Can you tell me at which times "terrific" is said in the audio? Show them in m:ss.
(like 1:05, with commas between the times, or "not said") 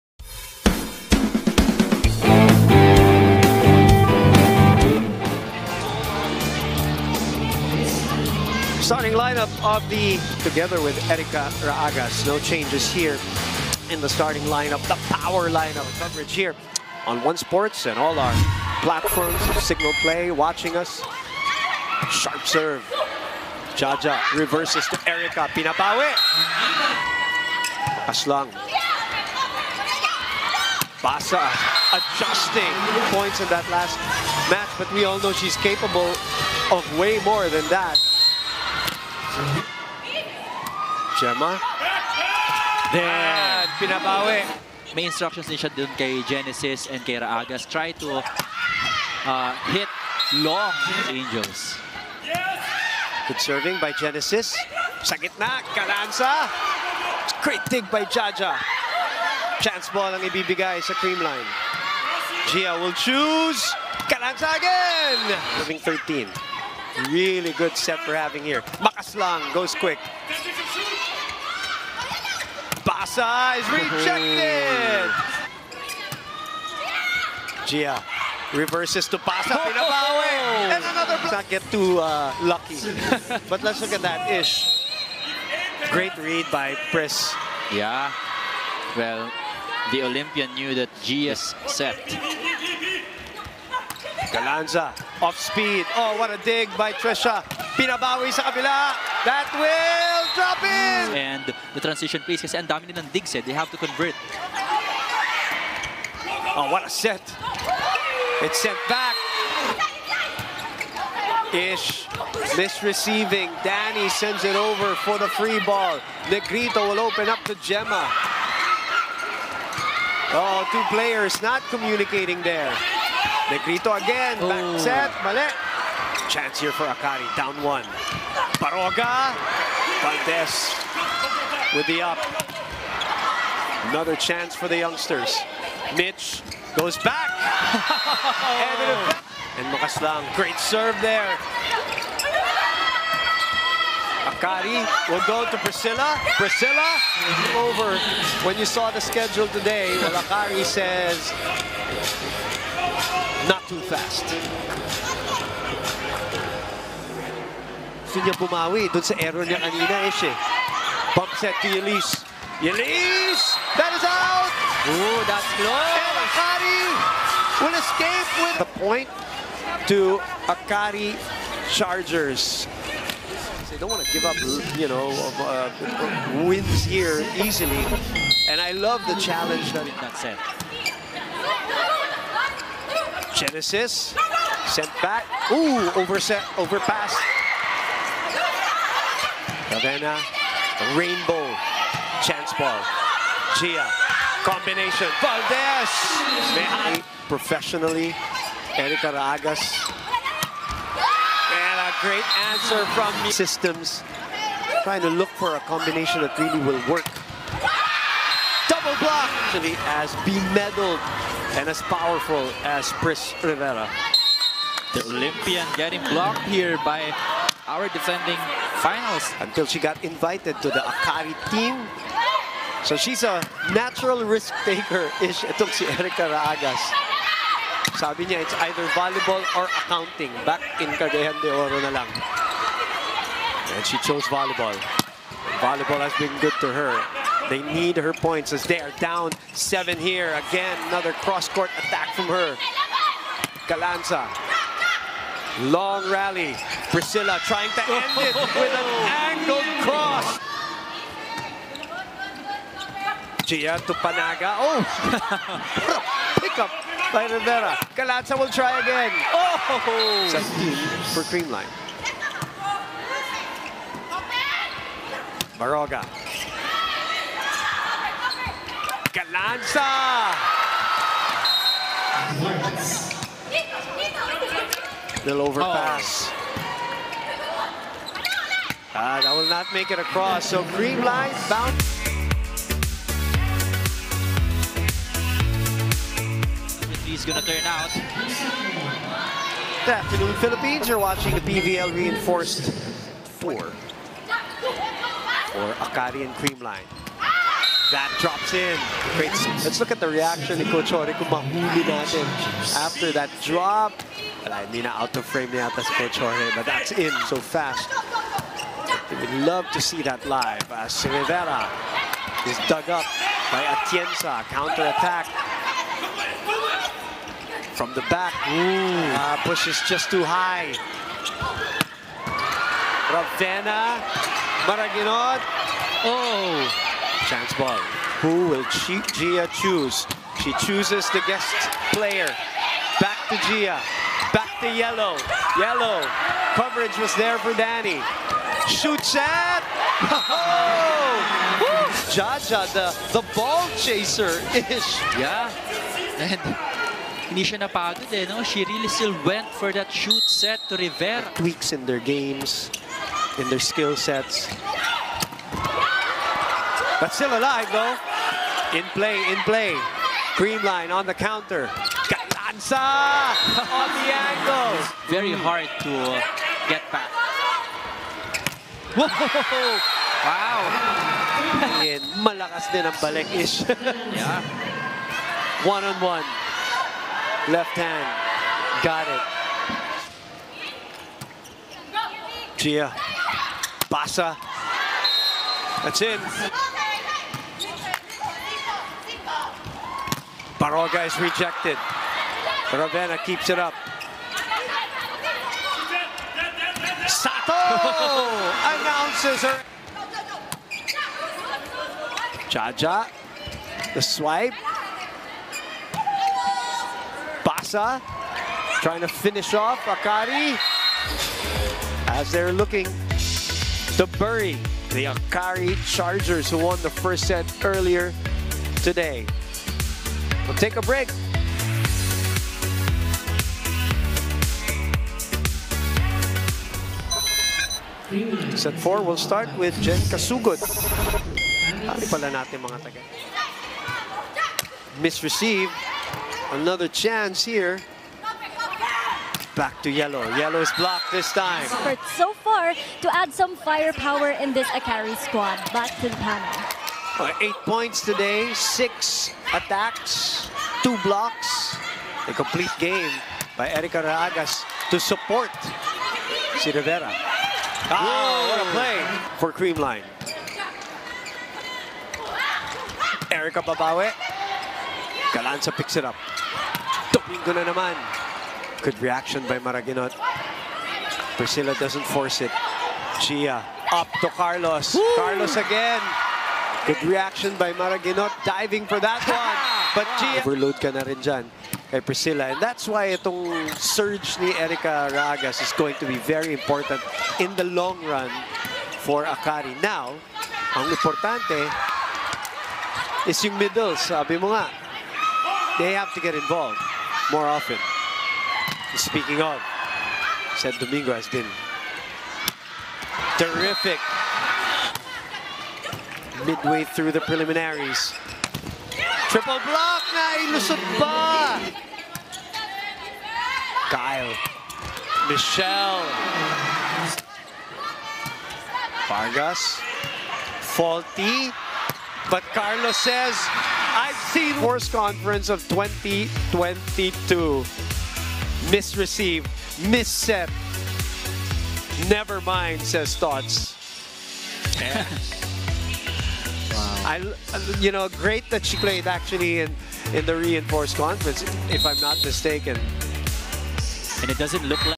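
8:23.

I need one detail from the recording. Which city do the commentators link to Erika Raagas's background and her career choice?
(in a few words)
Cagayan de Oro.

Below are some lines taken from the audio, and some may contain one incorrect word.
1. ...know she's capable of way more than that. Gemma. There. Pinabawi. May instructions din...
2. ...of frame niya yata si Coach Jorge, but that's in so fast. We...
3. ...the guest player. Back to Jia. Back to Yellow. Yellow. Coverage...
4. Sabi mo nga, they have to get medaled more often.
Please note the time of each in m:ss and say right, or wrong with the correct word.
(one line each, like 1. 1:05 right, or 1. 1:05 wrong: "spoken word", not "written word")
1. 0:35 right
2. 5:05 right
3. 5:31 right
4. 8:13 wrong: "involved", not "medaled".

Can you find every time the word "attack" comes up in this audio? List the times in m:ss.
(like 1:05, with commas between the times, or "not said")
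4:01, 5:14, 7:29.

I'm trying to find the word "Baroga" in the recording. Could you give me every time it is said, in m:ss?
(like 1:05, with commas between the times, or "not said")
2:08, 4:25.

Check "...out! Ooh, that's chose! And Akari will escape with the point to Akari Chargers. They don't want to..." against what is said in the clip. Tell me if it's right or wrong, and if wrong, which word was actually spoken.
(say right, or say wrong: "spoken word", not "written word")
wrong: "close", not "chose".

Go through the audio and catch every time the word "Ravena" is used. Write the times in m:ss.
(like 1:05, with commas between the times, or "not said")
3:09, 5:23, 6:32.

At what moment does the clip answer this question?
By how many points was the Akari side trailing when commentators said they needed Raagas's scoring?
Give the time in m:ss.
3:59.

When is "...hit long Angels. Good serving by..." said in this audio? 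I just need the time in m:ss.
0:49.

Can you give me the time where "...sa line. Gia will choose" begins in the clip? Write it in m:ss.
1:00.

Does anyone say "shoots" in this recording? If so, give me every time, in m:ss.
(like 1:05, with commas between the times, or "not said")
5:38, 5:49.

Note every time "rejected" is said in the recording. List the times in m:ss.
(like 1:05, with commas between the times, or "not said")
1:13, 6:31.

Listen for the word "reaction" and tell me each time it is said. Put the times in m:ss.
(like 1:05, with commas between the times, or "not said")
5:00, 7:49, 7:57.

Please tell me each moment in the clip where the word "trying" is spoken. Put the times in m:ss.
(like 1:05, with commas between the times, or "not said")
3:24, 4:07, 6:48.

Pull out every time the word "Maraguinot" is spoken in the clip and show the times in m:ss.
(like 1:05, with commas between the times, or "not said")
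5:24, 7:49, 7:57.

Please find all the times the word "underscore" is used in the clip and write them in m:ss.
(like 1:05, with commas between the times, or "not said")
not said.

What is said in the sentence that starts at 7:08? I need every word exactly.
Set 4 will start with Jen Kasugod.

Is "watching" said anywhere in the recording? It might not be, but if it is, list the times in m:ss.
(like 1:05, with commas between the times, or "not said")
0:20, 4:50.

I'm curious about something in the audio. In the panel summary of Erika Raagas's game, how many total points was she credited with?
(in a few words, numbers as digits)
8.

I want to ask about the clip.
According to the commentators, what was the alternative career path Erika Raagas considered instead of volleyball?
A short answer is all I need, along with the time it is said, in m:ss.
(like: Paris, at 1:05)
Accounting, at 3:49.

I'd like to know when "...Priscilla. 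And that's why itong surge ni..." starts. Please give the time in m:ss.
8:02.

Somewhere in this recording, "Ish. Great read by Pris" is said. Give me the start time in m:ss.
1:24.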